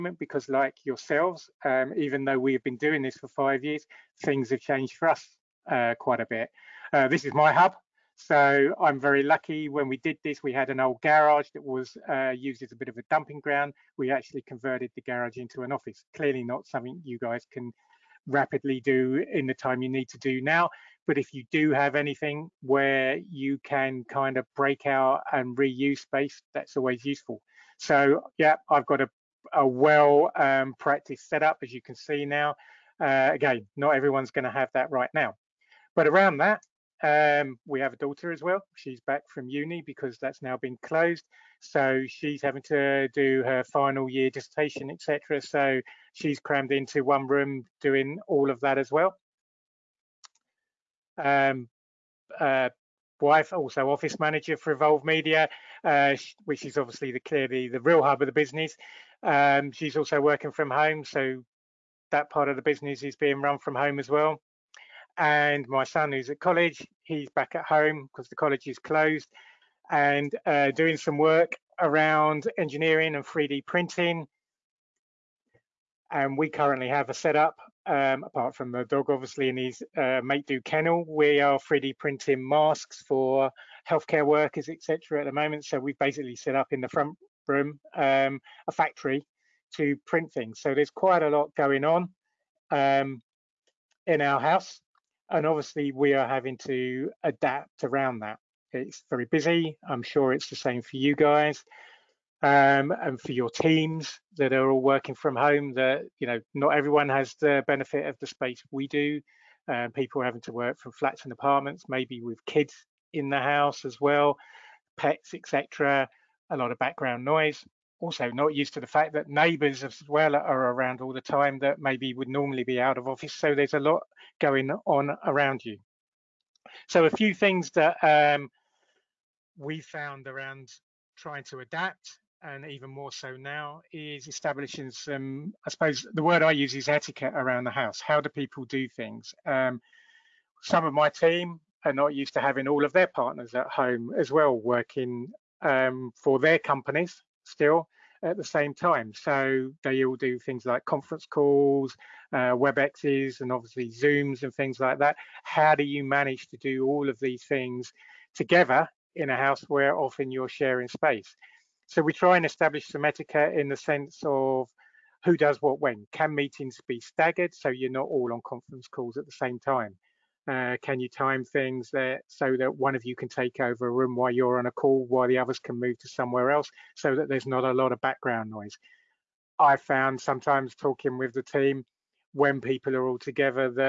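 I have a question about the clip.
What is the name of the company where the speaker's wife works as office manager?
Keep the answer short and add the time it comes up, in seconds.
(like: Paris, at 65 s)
Evolved Media, at 54 s.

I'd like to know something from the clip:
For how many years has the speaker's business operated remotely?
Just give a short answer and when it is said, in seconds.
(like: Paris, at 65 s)
5, at 3 s.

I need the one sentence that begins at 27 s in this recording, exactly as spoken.
So yeah, I've got a, a well um, practiced setup, as you can see now.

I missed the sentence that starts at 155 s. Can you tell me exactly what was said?
How do you manage to do all of these things together in a house where often you're sharing space?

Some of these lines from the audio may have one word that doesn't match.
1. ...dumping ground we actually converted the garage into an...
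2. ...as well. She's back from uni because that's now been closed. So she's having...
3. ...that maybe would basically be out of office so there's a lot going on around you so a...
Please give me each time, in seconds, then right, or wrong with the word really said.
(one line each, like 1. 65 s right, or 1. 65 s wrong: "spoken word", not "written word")
1. 13 s right
2. 38 s right
3. 121 s wrong: "normally", not "basically".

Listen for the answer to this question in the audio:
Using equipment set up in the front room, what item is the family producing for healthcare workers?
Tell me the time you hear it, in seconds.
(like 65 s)
82 s.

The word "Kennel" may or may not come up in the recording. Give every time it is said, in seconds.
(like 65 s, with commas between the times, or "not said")
80 s.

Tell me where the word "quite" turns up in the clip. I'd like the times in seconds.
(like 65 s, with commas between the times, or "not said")
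5 s, 90 s.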